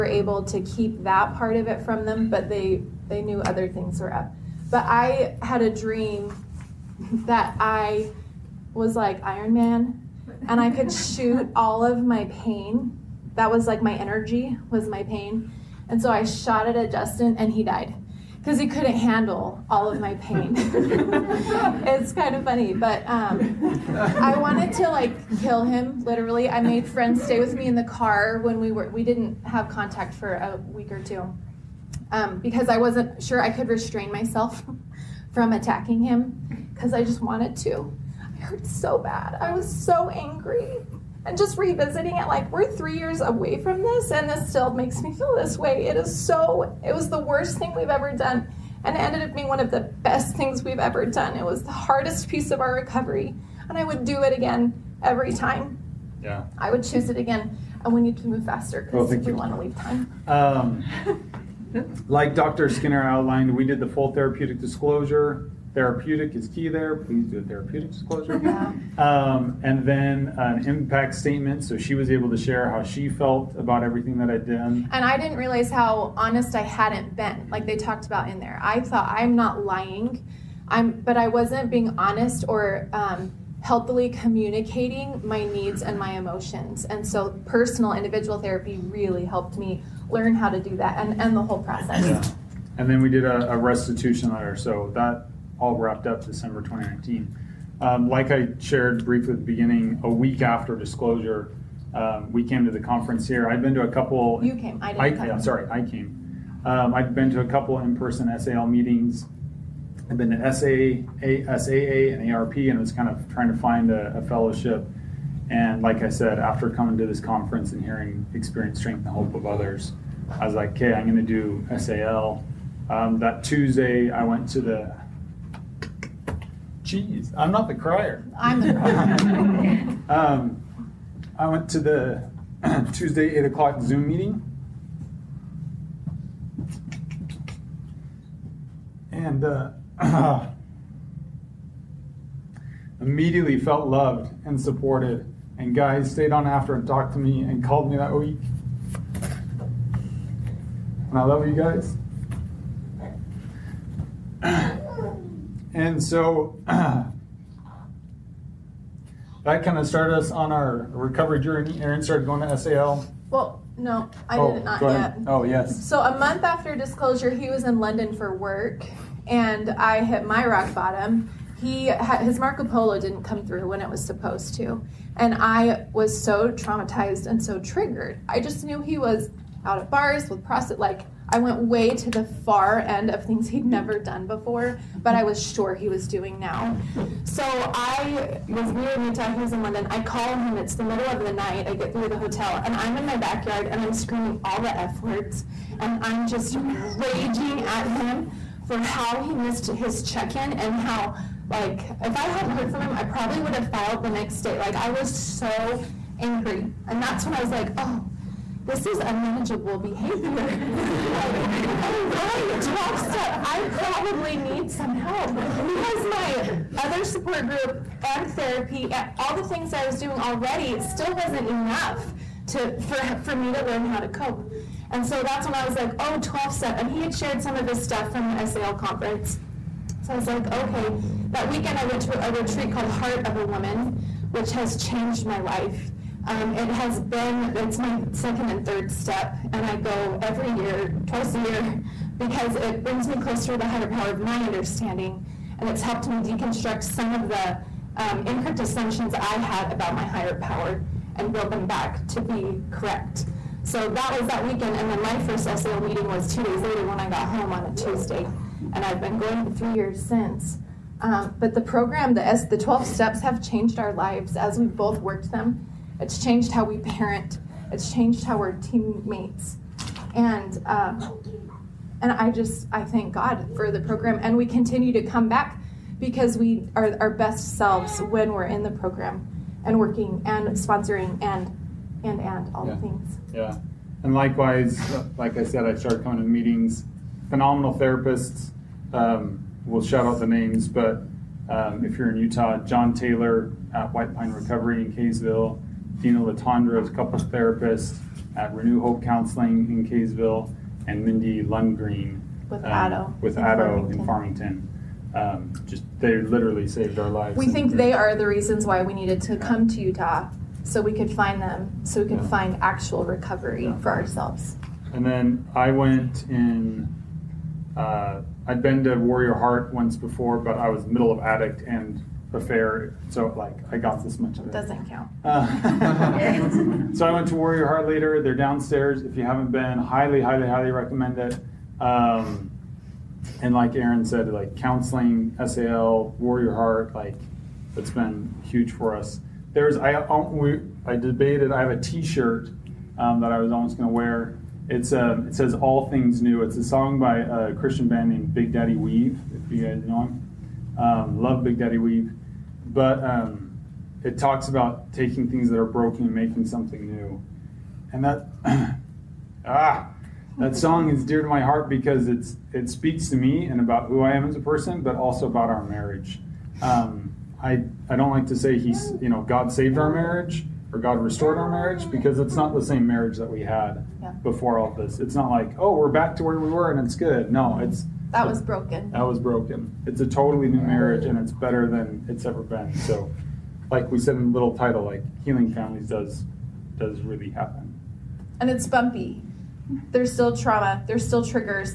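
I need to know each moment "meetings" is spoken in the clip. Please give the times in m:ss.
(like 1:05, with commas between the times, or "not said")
1:48, 2:14, 4:15, 4:46.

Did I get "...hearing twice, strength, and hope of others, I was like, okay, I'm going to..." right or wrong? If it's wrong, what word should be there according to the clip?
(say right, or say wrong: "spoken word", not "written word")
wrong: "experience", not "twice".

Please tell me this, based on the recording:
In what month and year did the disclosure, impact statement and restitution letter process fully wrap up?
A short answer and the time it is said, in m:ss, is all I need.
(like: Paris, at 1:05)
December 2019, at 1:36.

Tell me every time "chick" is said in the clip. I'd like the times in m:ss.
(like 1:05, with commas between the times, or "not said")
not said.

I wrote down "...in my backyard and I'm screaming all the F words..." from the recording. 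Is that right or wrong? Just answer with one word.
right.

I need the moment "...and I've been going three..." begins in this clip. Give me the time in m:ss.
4:18.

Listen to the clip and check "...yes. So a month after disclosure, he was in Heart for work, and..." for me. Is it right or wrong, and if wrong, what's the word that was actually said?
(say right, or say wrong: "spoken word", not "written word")
wrong: "London", not "Heart".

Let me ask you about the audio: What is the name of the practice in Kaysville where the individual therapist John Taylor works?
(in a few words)
White Pine Recovery.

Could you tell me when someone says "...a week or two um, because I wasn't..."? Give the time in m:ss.
0:30.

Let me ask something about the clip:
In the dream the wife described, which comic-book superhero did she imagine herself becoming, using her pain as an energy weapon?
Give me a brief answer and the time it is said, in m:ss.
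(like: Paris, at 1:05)
Iron Man, at 0:09.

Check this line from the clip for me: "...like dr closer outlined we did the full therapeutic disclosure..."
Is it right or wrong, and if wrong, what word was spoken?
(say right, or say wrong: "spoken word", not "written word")
wrong: "skinner", not "closer".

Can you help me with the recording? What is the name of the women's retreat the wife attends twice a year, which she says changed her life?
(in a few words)
Heart of a Woman.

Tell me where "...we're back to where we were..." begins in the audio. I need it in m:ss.
6:15.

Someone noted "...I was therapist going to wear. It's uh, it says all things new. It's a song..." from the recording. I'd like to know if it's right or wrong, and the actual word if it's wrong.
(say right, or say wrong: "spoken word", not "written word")
wrong: "almost", not "therapist".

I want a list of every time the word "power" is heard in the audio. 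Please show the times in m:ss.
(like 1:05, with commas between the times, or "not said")
4:03, 4:10.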